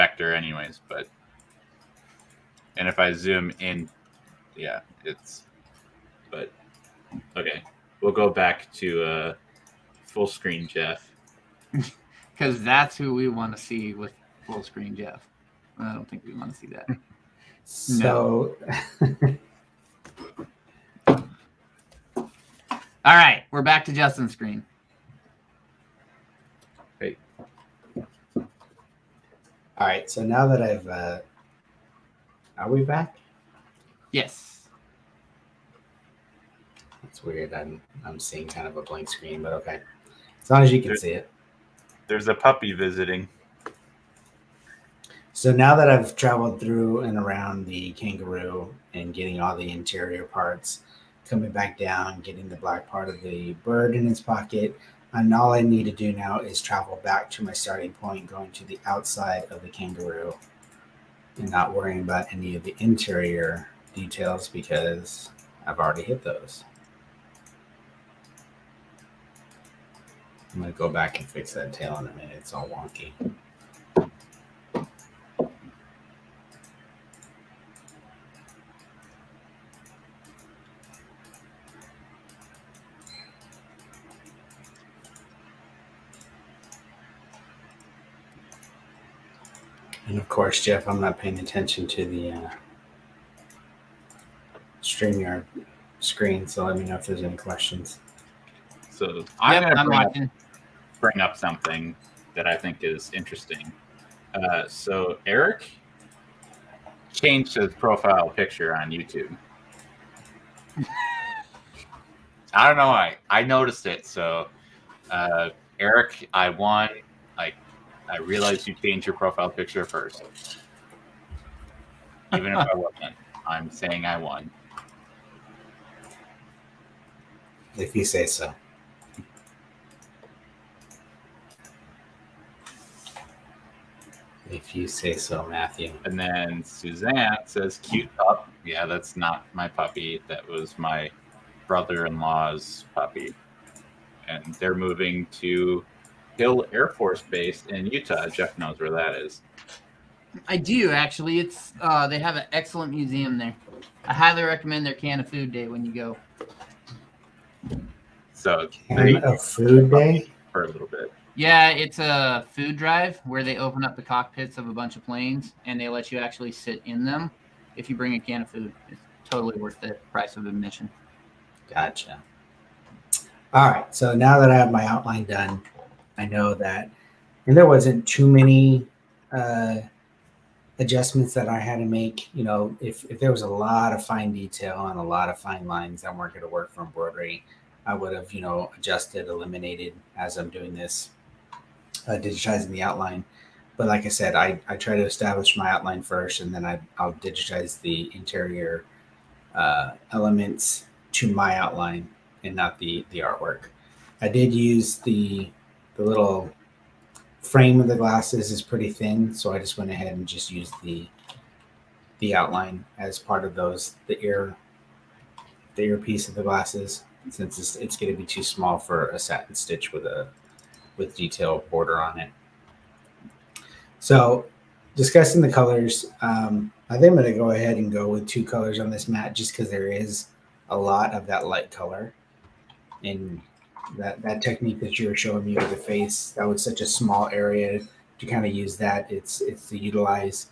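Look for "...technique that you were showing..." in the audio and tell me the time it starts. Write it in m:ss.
3:54.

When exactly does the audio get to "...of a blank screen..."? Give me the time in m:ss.
0:38.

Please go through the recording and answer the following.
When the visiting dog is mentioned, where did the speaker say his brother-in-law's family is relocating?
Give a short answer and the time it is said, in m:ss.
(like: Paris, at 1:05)
Hill Air Force Base, at 2:26.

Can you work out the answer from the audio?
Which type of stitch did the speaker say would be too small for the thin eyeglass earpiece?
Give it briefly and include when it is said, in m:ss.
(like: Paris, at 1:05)
satin stitch, at 3:39.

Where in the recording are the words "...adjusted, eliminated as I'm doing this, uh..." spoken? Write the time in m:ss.
3:08.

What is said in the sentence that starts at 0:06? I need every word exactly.
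But okay, we'll go back to uh, full screen Jeff.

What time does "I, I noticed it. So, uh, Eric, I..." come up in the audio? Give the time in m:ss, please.
1:52.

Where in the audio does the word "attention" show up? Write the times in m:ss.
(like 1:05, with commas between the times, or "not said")
1:31.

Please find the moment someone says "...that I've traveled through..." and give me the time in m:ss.
0:45.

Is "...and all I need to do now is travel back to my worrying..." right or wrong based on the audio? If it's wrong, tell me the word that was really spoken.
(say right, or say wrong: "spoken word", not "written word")
wrong: "starting", not "worrying".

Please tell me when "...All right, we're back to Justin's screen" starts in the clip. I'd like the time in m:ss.
0:22.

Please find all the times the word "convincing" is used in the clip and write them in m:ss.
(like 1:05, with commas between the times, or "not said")
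not said.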